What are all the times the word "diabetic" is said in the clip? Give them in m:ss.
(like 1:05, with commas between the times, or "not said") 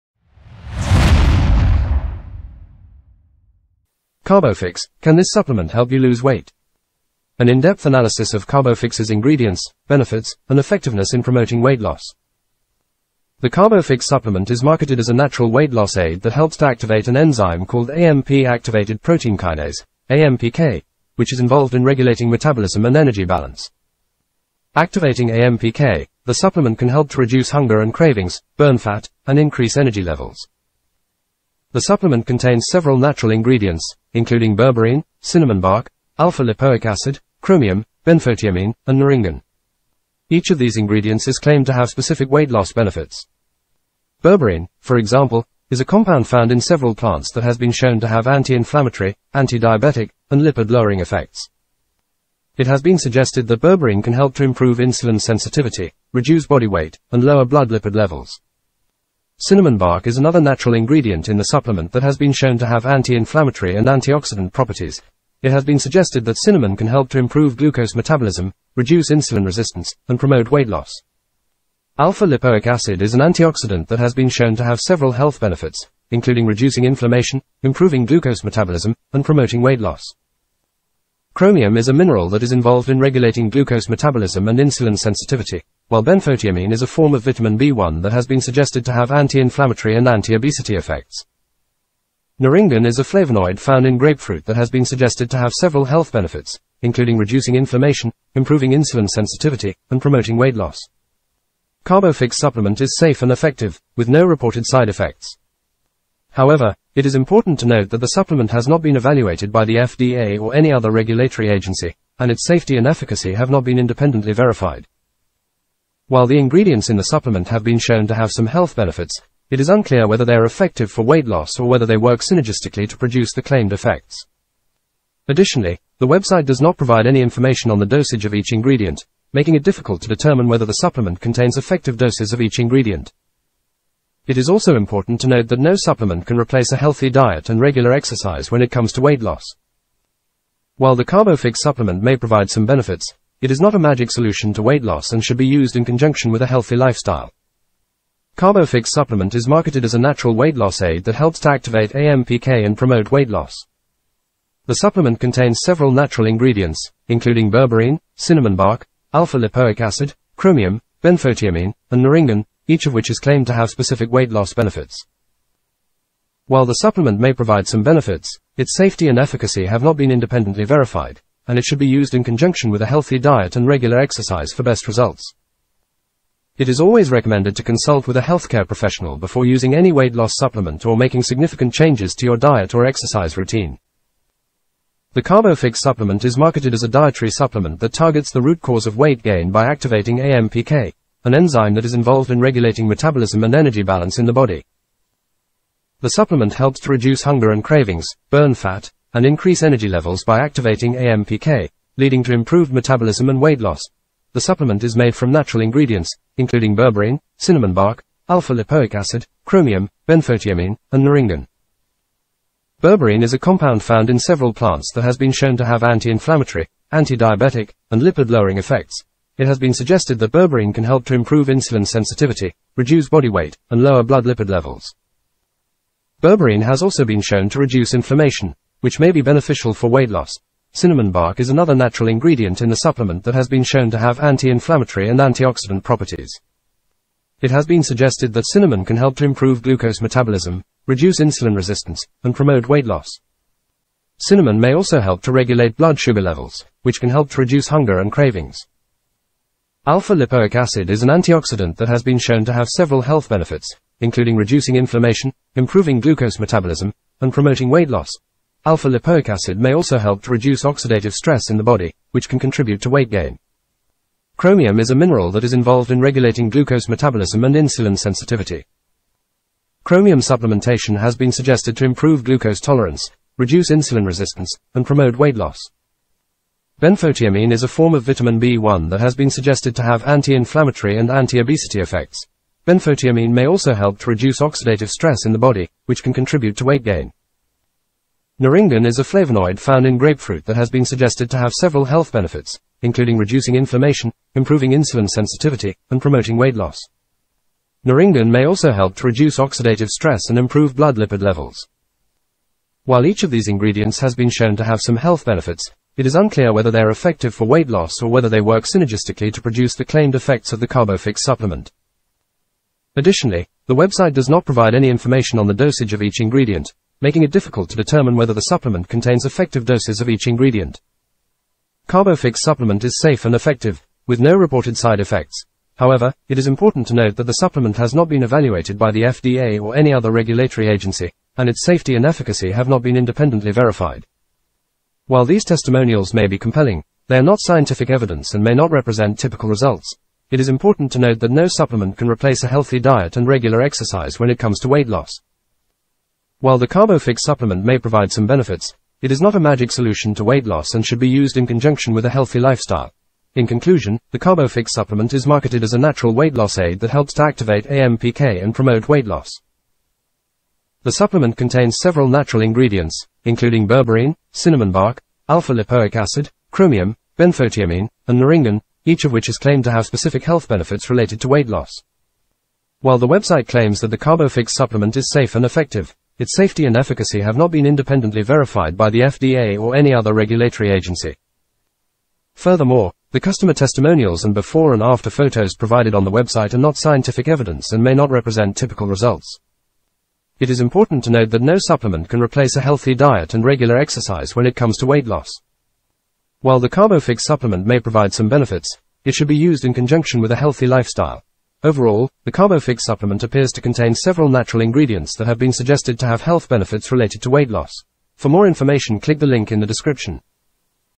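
0:49, 3:36.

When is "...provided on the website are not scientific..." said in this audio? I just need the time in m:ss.
6:25.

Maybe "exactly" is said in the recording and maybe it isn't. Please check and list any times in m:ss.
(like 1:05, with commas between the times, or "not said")
not said.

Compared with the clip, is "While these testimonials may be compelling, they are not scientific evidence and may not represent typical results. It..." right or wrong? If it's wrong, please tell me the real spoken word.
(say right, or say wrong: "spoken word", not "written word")
right.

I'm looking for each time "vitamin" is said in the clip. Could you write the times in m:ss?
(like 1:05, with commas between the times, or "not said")
1:27, 4:38.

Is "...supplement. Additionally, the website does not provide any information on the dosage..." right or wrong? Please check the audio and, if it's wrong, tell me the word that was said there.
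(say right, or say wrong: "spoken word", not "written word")
right.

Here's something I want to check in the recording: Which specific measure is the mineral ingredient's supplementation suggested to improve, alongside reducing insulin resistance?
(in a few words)
glucose tolerance.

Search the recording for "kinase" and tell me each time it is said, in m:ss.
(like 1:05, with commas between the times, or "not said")
0:19.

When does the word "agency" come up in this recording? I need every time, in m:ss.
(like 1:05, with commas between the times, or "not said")
1:51, 5:30, 6:20.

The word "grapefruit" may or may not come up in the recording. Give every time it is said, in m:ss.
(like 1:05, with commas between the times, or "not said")
1:33, 4:49.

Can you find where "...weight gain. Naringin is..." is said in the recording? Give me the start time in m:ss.
4:46.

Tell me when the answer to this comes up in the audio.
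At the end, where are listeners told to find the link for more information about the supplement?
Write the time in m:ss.
6:49.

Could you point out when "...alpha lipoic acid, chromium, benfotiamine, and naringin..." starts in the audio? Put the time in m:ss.
2:39.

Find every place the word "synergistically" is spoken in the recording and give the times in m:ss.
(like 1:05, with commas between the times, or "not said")
2:02, 5:08.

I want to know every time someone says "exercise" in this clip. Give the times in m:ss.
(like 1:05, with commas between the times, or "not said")
2:17, 2:53, 3:02, 5:43, 6:33.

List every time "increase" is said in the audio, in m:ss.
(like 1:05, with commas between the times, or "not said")
0:29, 3:19.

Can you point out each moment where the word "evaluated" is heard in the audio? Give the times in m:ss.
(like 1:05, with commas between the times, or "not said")
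1:48, 5:28.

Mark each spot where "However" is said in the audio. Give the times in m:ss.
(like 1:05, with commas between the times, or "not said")
1:46, 5:25.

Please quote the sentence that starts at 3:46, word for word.
Berberine has also been shown to reduce inflammation, which may be beneficial for weight loss.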